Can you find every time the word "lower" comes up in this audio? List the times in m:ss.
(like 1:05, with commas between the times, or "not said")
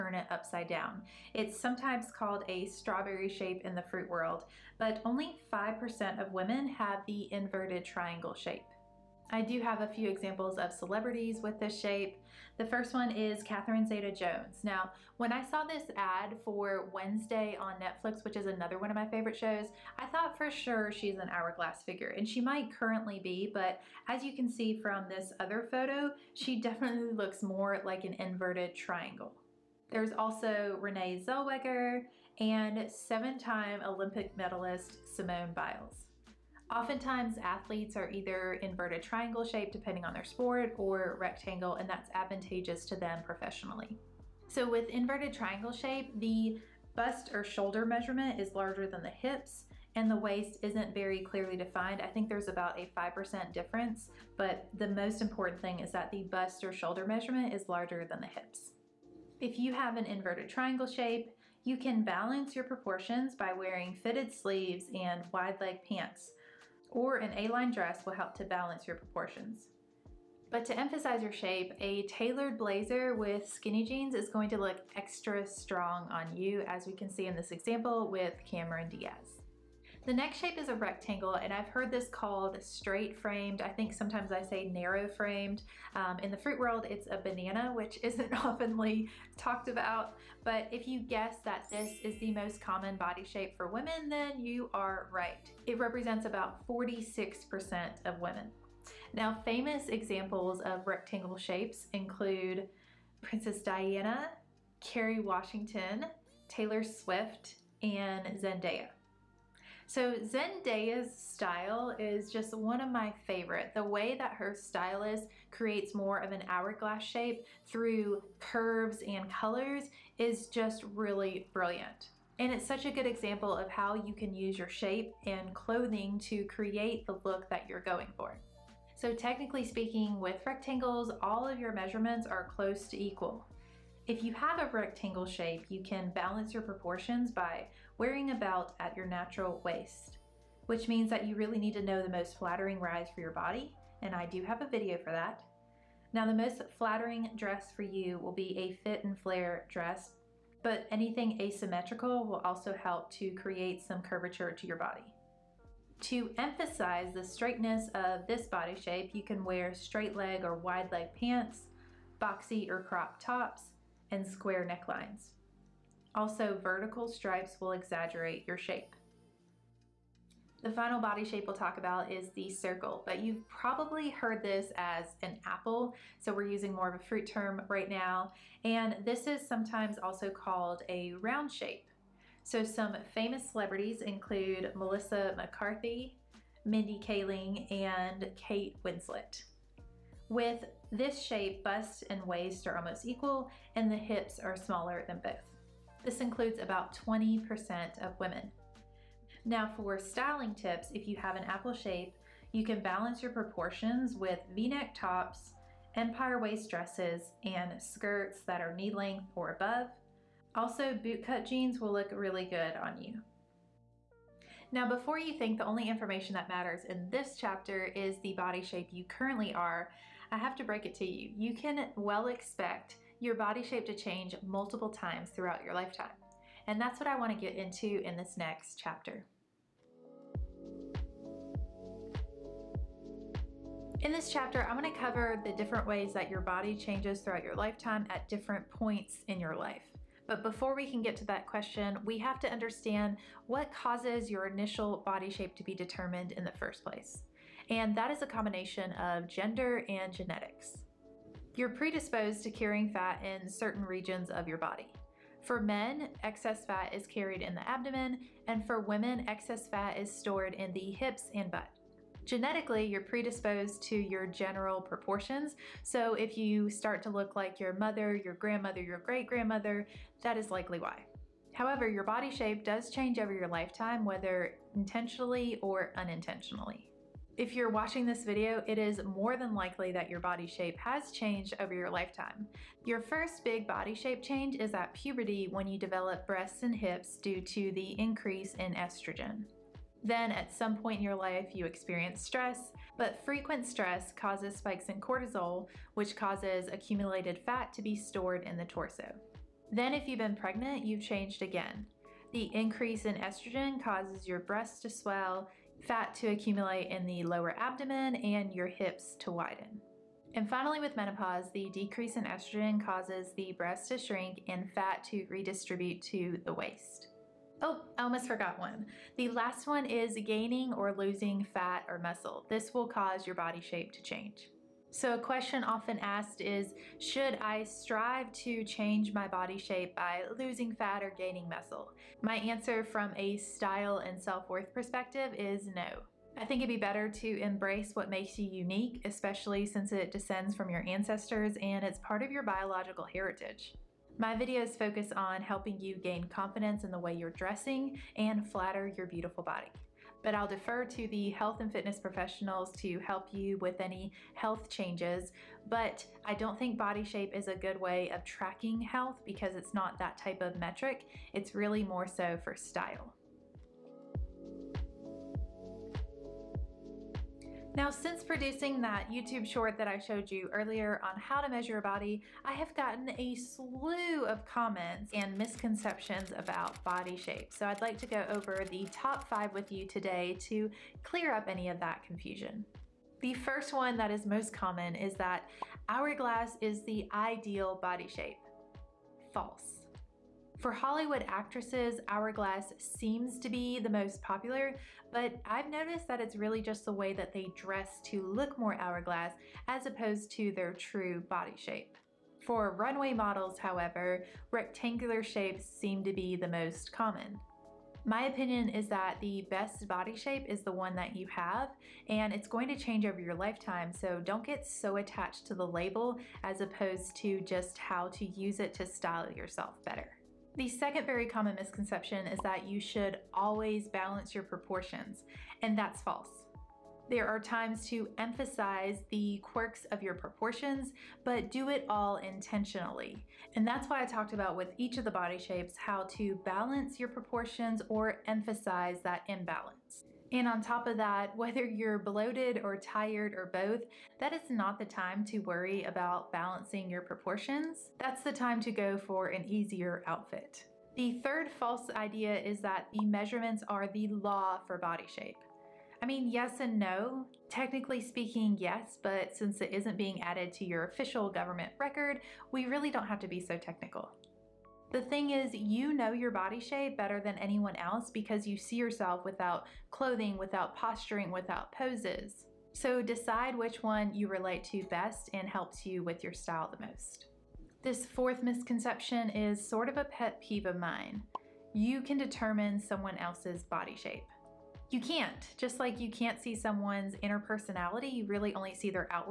5:07.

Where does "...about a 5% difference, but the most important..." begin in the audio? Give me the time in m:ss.
0:52.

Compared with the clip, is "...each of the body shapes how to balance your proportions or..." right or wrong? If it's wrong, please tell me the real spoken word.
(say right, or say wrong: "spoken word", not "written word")
right.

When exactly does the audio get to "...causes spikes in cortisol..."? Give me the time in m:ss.
4:54.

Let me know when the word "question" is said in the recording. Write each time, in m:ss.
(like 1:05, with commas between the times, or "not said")
4:01, 5:25.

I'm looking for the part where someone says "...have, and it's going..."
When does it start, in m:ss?
6:51.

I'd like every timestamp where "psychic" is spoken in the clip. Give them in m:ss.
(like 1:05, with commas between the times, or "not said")
not said.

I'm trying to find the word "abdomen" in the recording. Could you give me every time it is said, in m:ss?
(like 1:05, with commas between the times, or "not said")
4:17, 5:07.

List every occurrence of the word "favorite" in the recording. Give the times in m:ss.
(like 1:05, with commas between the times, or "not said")
0:19, 1:53.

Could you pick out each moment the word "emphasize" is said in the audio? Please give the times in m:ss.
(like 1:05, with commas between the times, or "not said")
1:10, 2:36, 7:08, 7:18.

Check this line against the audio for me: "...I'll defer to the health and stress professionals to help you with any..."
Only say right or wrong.
wrong.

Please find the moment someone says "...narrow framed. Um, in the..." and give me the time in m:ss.
1:24.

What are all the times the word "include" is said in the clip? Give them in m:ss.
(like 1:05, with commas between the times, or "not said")
1:41, 3:04, 3:16.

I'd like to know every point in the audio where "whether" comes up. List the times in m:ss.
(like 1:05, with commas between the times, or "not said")
4:34, 7:21.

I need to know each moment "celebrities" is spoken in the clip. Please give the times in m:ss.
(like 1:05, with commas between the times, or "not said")
0:10, 3:03.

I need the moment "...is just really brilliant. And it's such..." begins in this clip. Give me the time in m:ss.
2:00.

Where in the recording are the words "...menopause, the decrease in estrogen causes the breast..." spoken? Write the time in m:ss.
5:10.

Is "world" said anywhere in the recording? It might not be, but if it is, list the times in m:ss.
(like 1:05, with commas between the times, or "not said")
0:04, 1:26.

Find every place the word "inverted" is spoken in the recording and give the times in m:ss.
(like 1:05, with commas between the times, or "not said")
0:07, 0:28, 0:38, 0:44, 1:00.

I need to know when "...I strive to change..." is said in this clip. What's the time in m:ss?
5:27.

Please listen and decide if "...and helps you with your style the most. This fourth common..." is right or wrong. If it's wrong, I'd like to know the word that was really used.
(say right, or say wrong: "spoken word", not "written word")
wrong: "misconception", not "common".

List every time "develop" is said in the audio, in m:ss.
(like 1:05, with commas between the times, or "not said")
4:45.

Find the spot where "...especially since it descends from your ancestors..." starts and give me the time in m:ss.
5:39.